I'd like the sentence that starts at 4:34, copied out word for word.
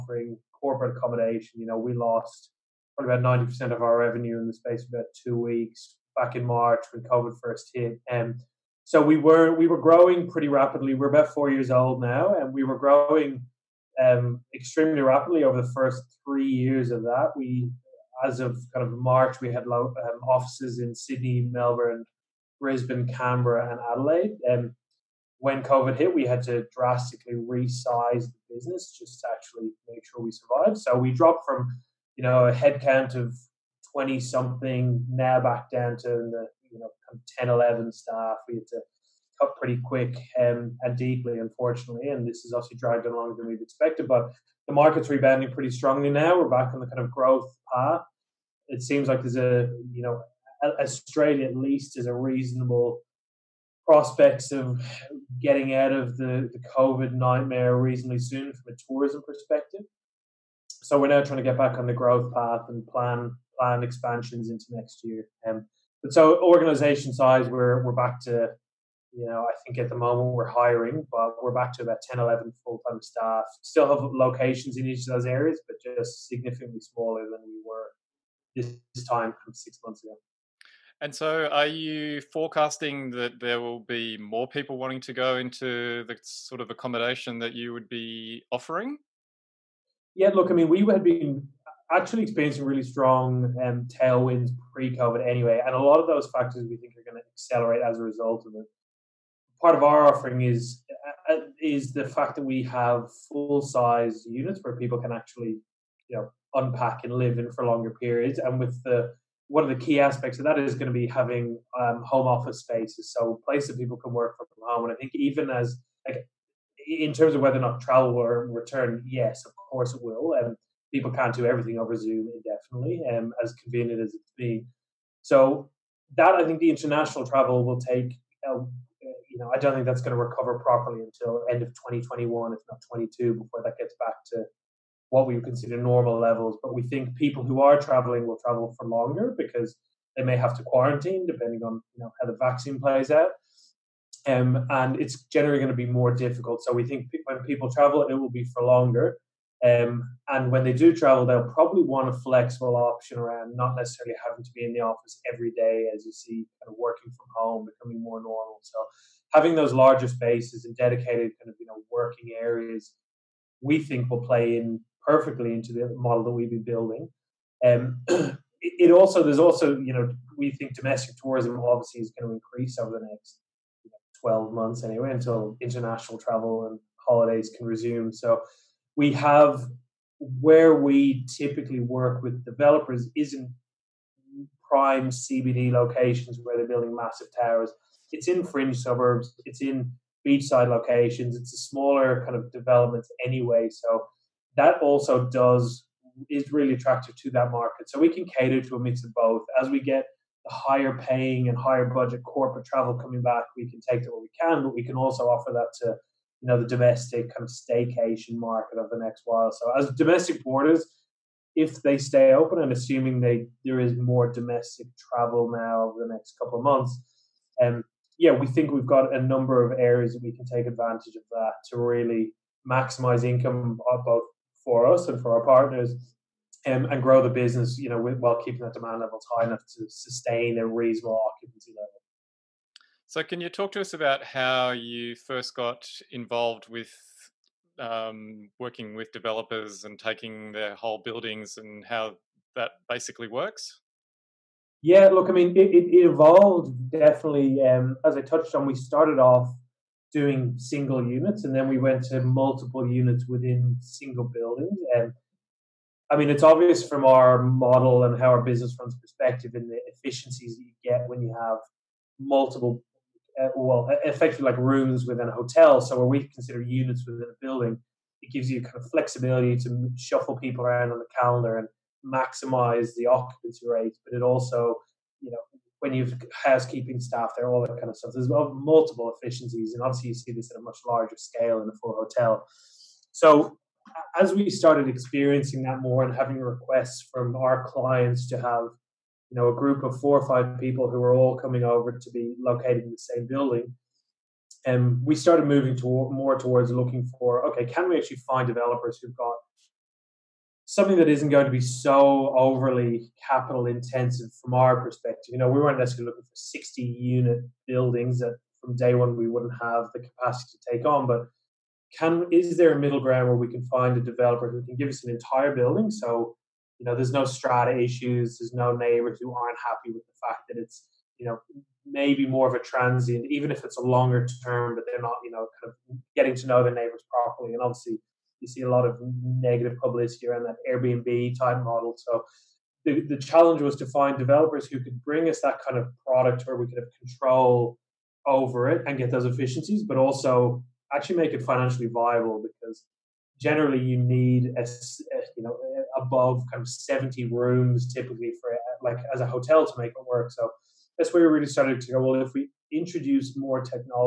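But it also, you know, when you've housekeeping staff there, all that kind of stuff.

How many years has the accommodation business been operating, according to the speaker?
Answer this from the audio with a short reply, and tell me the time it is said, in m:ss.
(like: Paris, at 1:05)
4, at 0:11.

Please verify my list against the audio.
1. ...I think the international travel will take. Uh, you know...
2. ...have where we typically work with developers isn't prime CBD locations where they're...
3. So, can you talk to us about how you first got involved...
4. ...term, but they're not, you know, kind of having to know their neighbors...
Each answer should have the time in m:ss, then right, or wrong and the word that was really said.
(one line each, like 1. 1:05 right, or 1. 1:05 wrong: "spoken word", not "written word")
1. 2:06 right
2. 2:59 right
3. 3:53 right
4. 5:24 wrong: "getting", not "having".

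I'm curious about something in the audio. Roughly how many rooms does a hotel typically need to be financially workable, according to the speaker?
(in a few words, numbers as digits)
70.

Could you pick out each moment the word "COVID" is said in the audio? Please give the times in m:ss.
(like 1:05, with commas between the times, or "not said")
0:07, 0:25, 0:56, 1:34.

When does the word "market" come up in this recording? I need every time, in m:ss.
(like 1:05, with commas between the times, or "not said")
0:44, 3:17, 3:28.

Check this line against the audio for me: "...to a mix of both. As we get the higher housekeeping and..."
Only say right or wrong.
wrong.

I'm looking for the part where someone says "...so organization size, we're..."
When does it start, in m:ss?
1:06.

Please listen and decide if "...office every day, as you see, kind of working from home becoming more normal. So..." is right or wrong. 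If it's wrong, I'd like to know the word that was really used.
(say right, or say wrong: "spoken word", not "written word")
right.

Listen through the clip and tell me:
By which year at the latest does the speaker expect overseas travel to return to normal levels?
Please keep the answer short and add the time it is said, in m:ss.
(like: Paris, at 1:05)
2022, at 2:12.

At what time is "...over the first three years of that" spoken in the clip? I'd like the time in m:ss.
0:15.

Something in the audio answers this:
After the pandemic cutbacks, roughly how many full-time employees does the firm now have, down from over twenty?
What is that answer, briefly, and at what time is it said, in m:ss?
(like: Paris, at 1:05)
10, 11, at 0:37.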